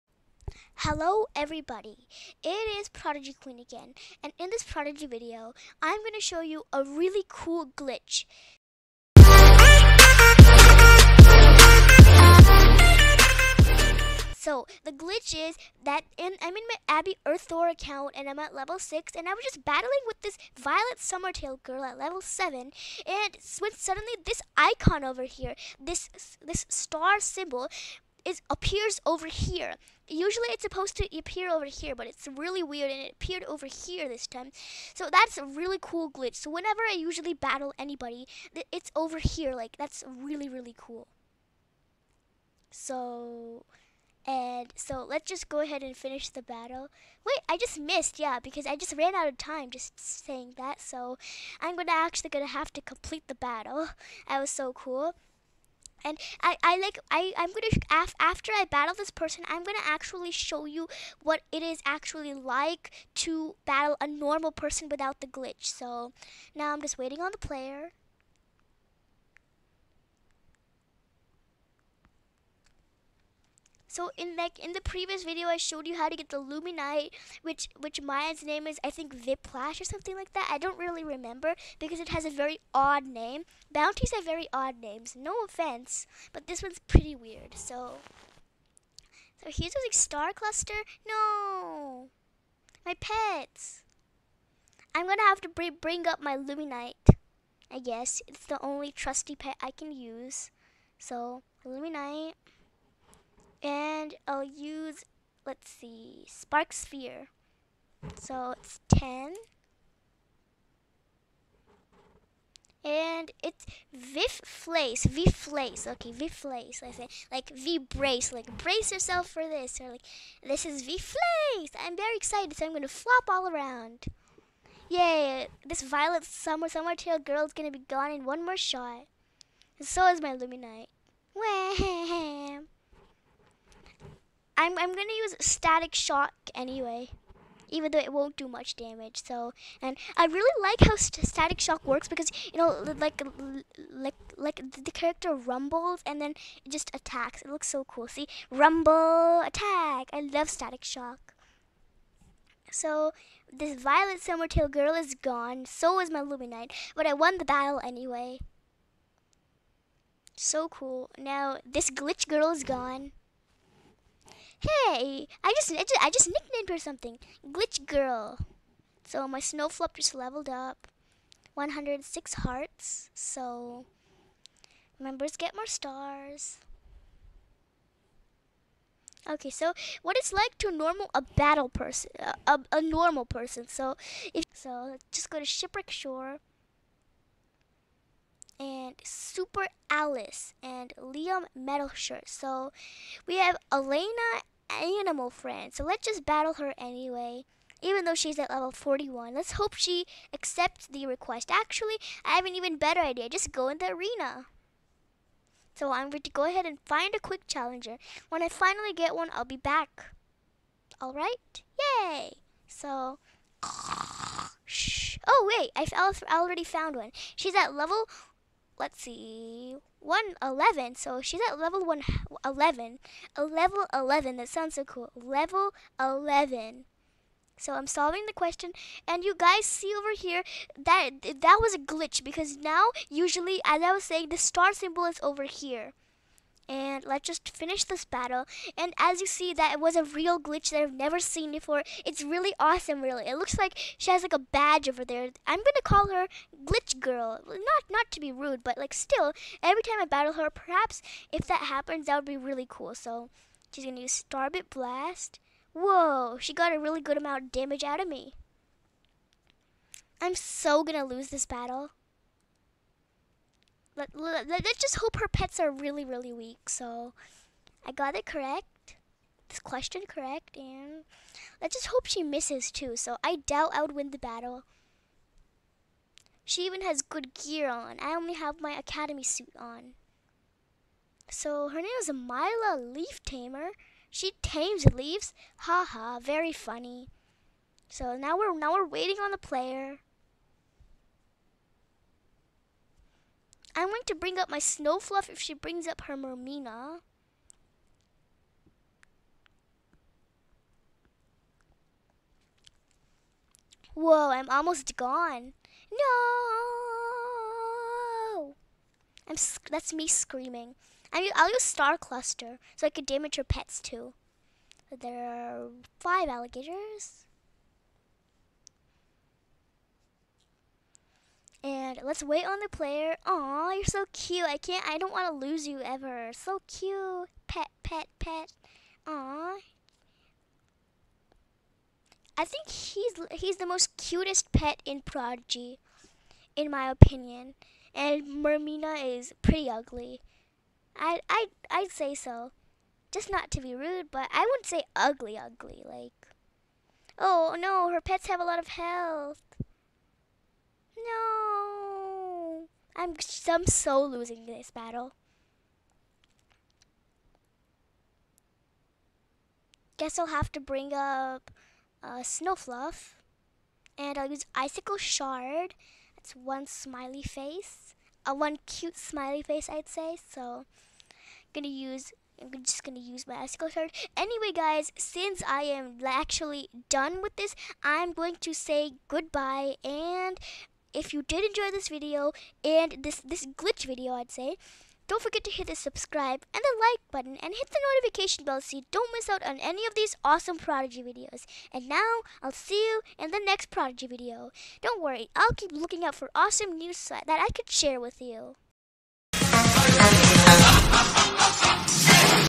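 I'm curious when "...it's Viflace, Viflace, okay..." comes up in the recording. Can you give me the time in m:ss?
1:53.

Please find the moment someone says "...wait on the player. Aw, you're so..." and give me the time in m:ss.
5:22.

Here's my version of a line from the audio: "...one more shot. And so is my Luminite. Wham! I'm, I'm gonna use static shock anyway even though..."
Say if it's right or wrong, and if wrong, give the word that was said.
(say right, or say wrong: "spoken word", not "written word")
right.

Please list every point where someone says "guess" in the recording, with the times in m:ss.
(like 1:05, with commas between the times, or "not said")
1:37, 5:59.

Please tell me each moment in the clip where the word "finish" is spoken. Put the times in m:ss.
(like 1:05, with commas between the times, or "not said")
0:45, 3:57.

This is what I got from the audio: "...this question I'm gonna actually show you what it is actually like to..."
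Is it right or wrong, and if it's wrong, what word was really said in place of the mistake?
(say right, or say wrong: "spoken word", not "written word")
wrong: "person", not "question".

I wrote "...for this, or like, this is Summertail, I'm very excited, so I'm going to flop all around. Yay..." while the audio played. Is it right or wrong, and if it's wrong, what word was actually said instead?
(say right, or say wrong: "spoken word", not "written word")
wrong: "Viflace", not "Summertail".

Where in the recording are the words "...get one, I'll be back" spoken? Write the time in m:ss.
3:28.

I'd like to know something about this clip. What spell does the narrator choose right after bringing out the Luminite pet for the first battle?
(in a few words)
Spark Sphere.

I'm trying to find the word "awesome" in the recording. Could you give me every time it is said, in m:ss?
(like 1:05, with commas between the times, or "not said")
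4:02, 6:30, 6:36.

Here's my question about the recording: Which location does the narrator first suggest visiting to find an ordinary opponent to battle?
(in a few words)
Shipwreck Shore.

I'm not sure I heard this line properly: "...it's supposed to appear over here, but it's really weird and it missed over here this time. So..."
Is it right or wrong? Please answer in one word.
wrong.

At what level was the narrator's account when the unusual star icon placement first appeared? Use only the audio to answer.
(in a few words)
6.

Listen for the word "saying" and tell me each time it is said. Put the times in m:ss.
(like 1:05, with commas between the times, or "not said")
0:49, 3:54.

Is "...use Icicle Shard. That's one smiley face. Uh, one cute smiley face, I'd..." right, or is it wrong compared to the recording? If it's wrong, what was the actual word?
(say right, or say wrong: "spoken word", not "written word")
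right.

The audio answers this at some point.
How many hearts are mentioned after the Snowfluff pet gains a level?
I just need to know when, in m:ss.
2:51.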